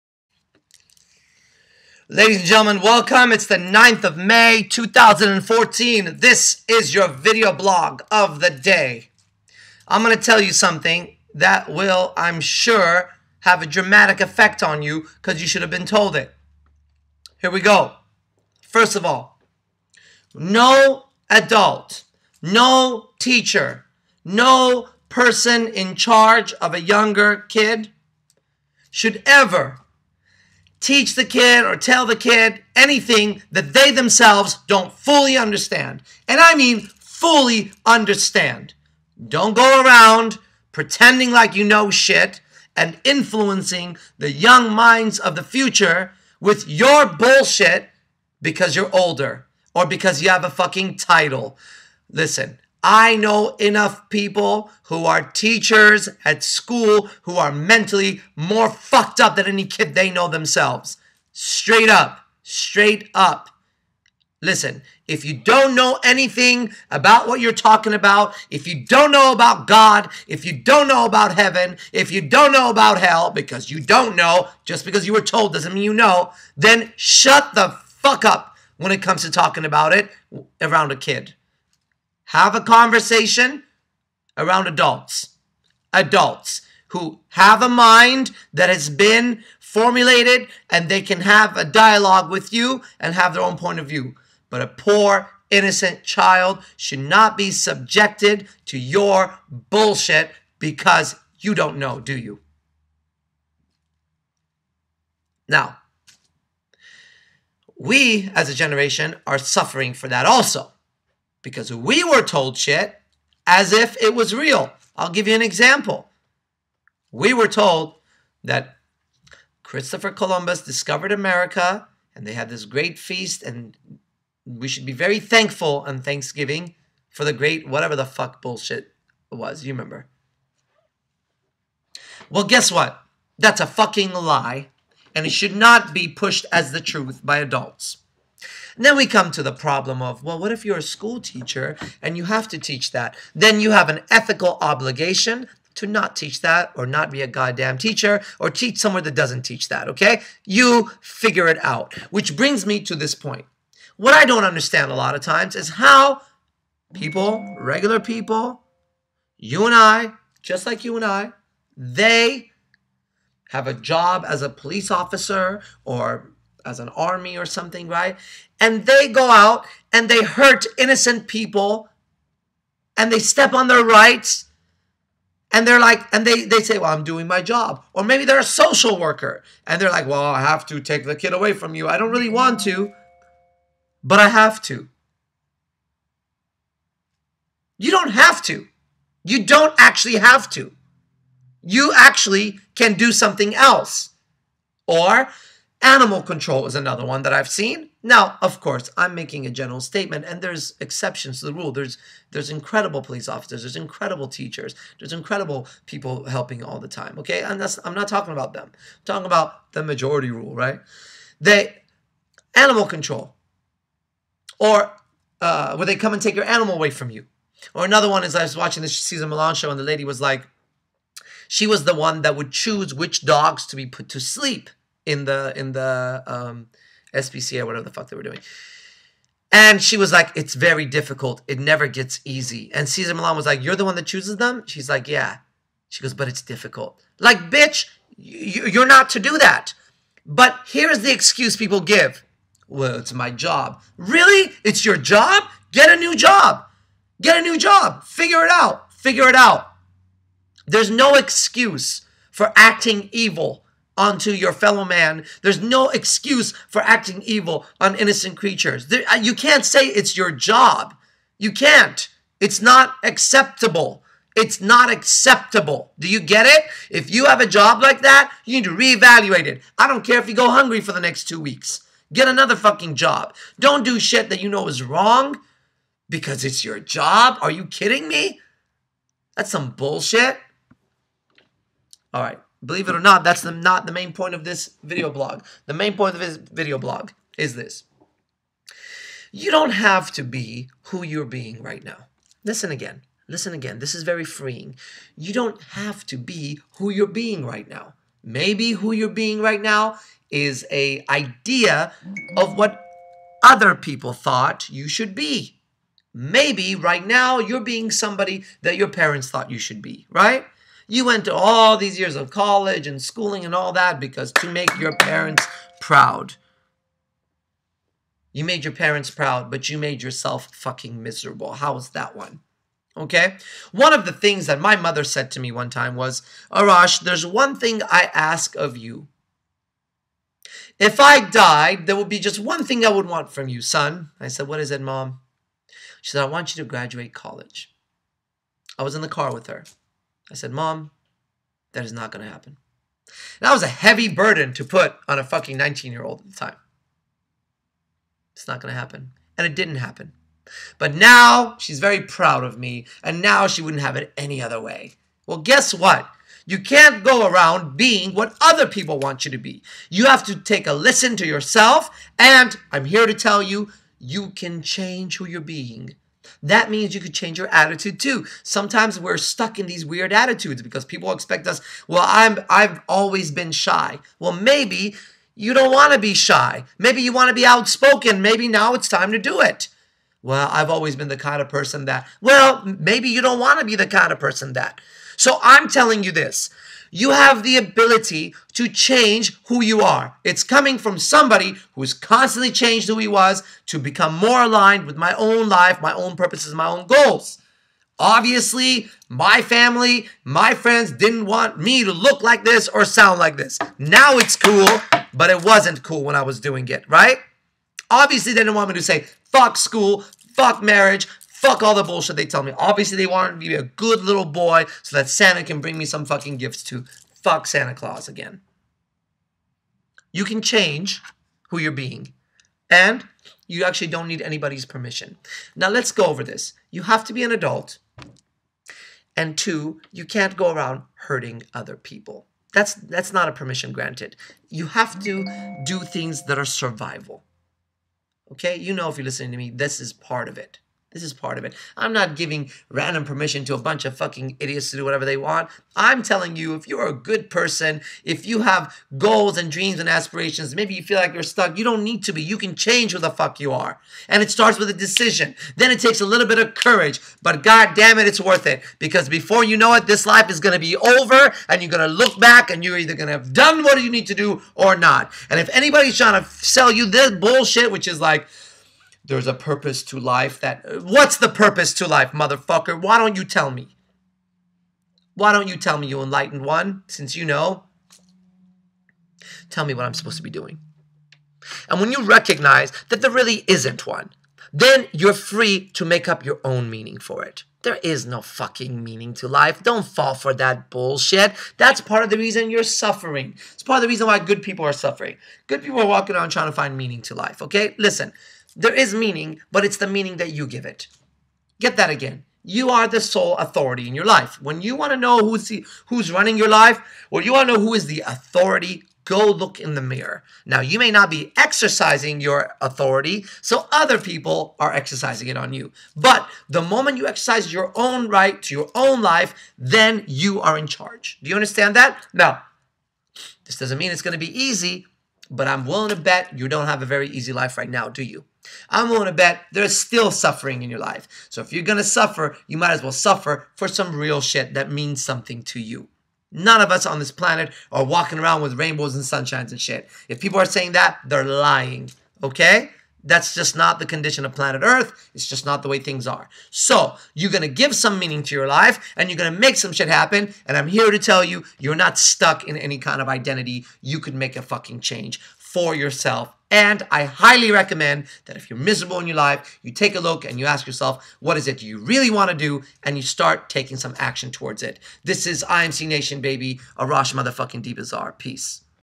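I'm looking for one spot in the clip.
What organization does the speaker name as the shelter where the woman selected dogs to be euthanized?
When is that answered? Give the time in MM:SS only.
03:47.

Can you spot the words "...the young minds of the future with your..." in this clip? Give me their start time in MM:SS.
00:44.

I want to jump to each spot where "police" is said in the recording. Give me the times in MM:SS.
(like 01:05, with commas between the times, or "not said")
02:44, 03:23.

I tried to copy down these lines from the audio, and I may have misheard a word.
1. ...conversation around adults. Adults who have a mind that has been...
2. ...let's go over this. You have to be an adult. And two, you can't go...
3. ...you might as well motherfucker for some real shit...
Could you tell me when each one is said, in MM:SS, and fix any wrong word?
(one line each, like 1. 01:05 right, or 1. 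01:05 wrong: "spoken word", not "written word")
1. 01:22 right
2. 07:05 right
3. 08:52 wrong: "suffer", not "motherfucker".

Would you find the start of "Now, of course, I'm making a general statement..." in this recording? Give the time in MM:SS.
03:18.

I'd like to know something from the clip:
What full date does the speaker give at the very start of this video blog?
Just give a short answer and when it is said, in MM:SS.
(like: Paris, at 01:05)
9 May 2014, at 00:03.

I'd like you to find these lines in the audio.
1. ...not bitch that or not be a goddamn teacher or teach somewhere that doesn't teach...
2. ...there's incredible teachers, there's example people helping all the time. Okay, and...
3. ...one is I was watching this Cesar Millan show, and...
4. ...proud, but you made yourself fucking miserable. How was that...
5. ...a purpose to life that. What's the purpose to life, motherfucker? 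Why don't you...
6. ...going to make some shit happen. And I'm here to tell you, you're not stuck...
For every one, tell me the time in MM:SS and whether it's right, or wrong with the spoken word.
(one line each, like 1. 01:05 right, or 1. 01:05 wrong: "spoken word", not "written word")
1. 02:25 wrong: "teach", not "bitch"
2. 03:23 wrong: "incredible", not "example"
3. 03:38 right
4. 05:19 right
5. 07:49 right
6. 09:09 right.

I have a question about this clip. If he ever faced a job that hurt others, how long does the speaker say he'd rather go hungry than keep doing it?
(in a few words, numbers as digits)
two weeks.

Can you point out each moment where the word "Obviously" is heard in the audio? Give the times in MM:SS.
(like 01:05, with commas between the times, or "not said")
06:37, 06:47, 06:52.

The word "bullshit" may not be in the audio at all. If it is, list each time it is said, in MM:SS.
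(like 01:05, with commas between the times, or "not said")
00:47, 01:39, 02:08, 04:39, 06:51, 07:47, 08:10.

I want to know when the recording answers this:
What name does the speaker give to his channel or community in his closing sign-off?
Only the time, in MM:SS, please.
09:25.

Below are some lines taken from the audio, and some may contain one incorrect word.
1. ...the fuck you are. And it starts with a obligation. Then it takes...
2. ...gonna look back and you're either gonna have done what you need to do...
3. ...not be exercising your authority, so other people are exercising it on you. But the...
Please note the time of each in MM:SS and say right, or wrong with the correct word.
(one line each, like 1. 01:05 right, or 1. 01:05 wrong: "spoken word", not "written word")
1. 07:32 wrong: "decision", not "obligation"
2. 07:41 right
3. 08:30 right.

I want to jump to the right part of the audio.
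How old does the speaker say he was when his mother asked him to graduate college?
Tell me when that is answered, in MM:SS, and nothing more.
05:45.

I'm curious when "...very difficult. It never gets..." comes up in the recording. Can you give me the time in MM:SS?
03:50.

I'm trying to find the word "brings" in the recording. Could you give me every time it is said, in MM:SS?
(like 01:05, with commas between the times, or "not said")
02:32, 06:55.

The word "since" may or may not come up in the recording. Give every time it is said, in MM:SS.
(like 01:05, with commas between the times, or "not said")
07:56.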